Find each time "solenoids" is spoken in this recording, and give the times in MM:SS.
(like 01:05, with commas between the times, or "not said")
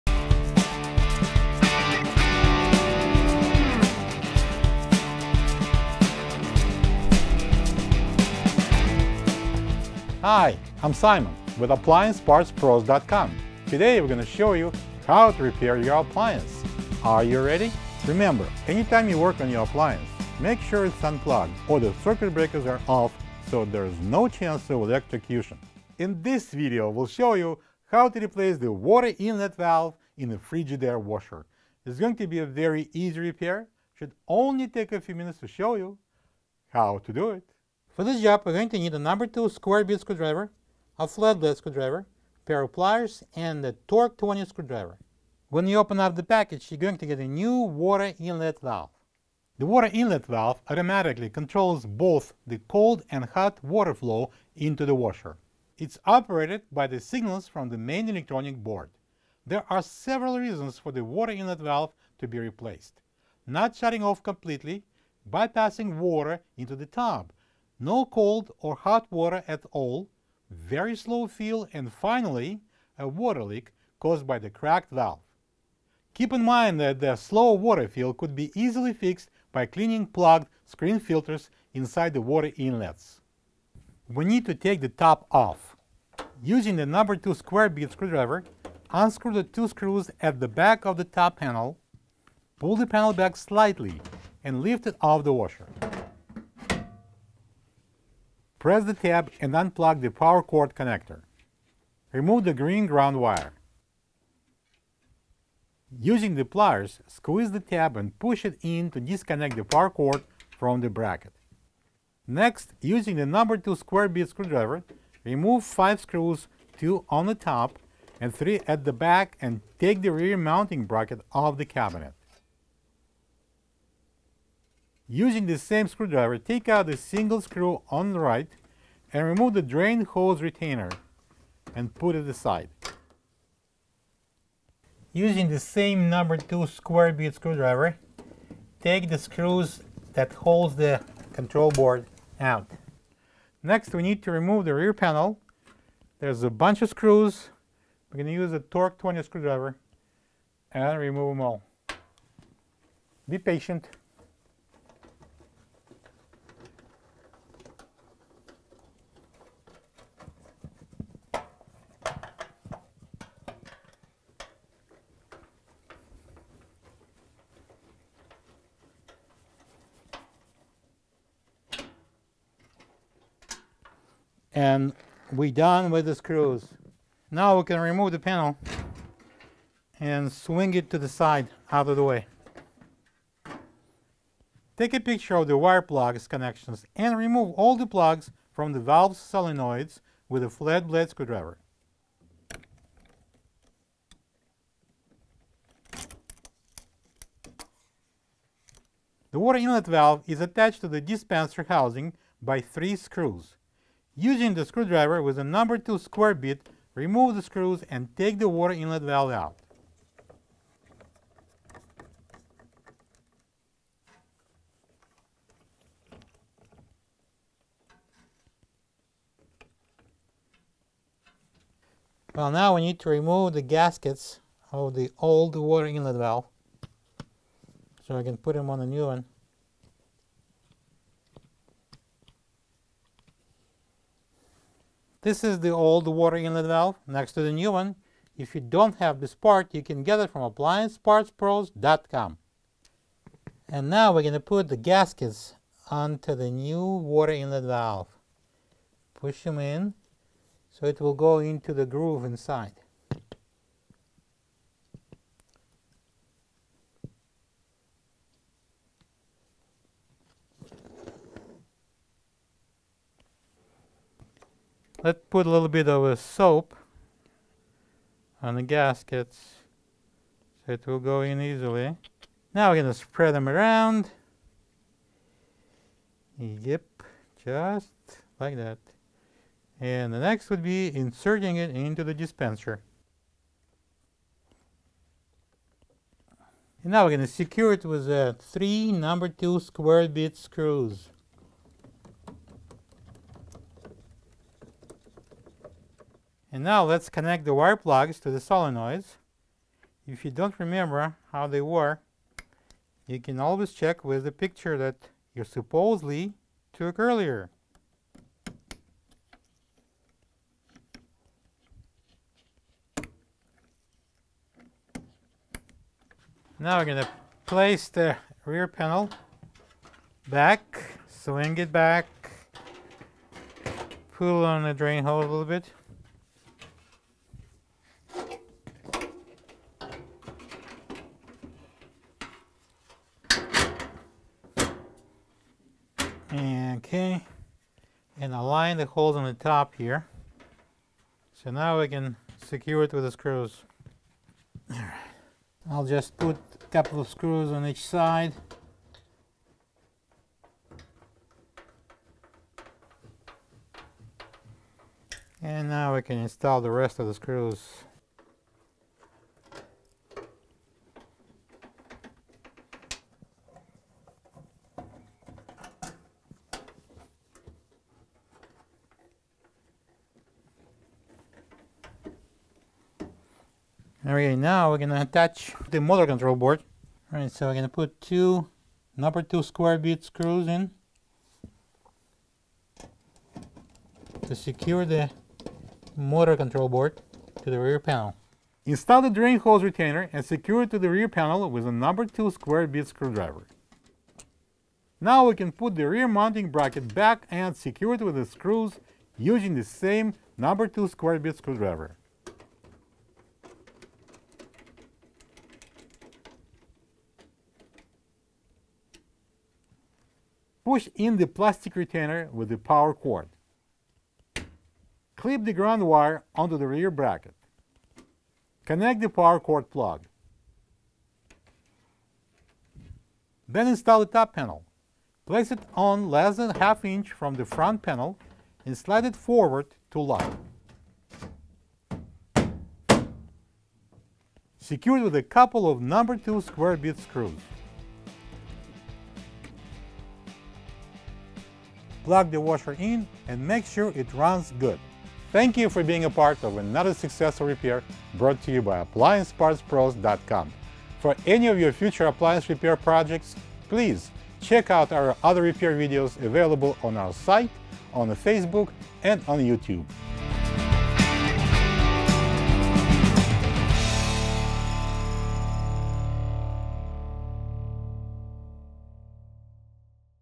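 03:09, 04:58.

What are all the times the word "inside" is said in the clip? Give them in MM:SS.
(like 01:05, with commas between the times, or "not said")
01:21, 04:12.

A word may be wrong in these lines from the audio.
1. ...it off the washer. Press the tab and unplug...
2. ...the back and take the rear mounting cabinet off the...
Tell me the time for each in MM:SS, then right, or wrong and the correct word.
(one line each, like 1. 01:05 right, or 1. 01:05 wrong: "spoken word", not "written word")
1. 01:34 right
2. 01:58 wrong: "bracket", not "cabinet".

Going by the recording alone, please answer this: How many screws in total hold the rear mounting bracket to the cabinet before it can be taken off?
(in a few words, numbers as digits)
5.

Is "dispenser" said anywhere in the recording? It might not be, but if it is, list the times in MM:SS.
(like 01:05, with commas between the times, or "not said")
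03:21, 04:42.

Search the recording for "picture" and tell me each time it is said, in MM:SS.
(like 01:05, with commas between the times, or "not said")
03:04, 05:04.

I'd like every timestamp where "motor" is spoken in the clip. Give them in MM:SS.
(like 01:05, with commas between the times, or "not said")
06:15, 06:25.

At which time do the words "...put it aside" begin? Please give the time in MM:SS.
02:11.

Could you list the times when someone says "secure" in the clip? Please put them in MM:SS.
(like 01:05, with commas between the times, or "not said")
04:47, 05:42, 06:24, 06:30, 06:37, 07:14.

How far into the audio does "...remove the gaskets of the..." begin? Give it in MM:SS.
03:43.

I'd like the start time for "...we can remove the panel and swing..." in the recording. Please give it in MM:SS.
02:57.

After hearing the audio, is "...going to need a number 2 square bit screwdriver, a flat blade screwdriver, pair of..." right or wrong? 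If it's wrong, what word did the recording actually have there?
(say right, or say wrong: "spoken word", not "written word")
right.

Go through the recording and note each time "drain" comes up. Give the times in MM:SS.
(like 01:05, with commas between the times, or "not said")
02:09, 05:24, 06:29.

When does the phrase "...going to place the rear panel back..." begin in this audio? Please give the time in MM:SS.
05:16.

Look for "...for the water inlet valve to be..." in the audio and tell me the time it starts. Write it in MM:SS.
01:00.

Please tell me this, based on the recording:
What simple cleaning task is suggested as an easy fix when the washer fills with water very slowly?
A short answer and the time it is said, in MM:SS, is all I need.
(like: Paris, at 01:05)
cleaning plugged screen filters, at 01:19.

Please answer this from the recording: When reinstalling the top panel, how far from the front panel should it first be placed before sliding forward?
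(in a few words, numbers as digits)
less than half inch.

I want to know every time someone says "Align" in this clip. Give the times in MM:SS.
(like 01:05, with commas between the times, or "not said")
05:38.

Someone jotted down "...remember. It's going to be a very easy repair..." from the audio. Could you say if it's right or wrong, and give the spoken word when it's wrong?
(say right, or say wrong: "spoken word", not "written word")
wrong: "washer", not "remember".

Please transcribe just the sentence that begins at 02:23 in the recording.
Next we need to remove the rear panel.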